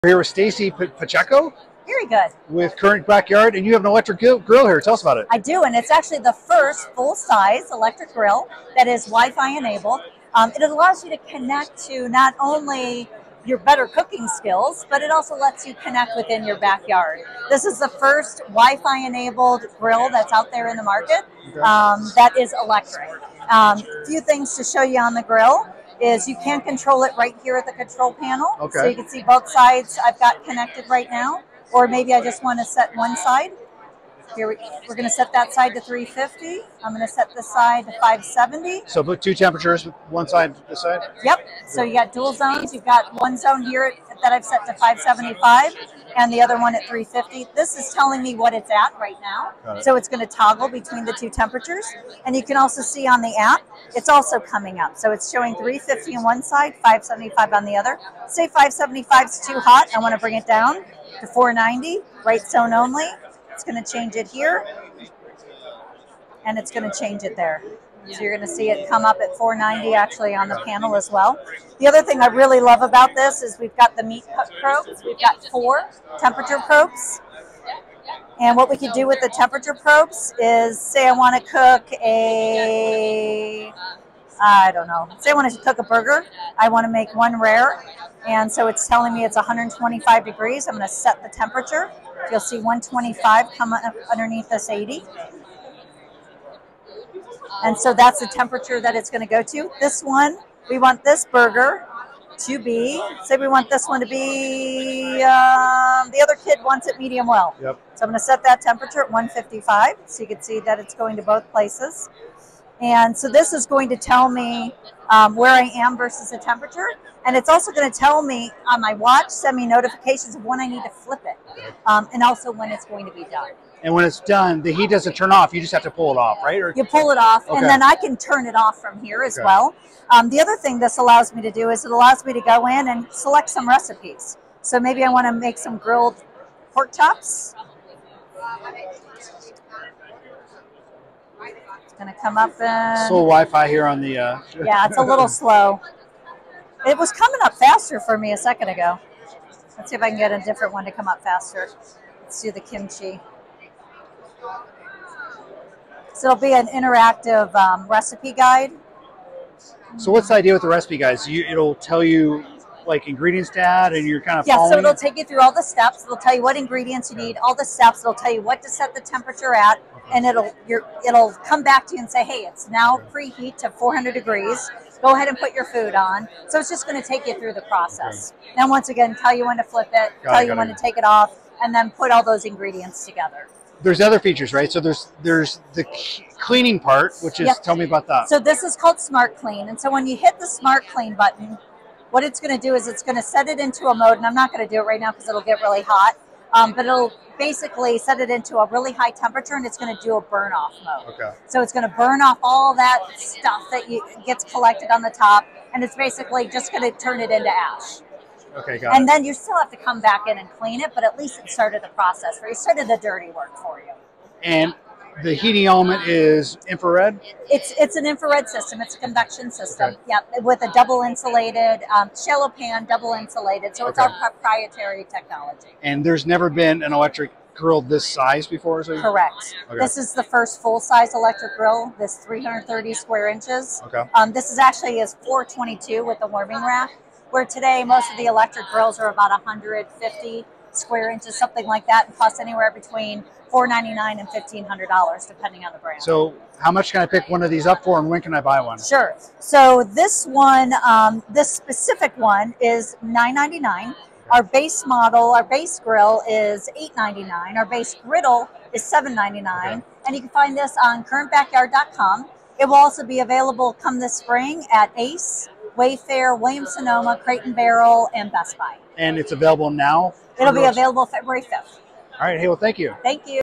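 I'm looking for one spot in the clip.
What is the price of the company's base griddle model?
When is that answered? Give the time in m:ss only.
4:18.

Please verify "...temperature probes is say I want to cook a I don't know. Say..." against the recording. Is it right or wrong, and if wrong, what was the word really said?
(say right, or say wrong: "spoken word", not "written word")
right.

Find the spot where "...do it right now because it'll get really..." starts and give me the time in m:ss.
3:14.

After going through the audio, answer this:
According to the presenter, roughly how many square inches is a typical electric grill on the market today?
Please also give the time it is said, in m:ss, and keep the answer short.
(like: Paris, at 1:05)
150, at 3:59.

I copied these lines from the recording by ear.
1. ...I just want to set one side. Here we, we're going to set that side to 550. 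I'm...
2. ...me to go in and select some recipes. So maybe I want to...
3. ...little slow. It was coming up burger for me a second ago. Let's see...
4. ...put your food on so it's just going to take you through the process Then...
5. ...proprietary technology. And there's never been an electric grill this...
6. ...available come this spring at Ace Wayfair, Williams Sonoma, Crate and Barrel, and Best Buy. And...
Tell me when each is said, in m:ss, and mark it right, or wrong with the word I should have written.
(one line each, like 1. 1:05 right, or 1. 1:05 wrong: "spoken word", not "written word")
1. 0:32 wrong: "350", not "550"
2. 2:12 right
3. 2:25 wrong: "faster", not "burger"
4. 2:55 right
5. 3:44 right
6. 4:23 right.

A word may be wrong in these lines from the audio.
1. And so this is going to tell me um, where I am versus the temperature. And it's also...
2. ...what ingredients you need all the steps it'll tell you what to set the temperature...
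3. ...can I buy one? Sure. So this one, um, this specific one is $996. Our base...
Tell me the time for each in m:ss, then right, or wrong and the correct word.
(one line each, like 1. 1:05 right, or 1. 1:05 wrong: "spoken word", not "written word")
1. 1:52 right
2. 2:46 right
3. 4:08 wrong: "999", not "996".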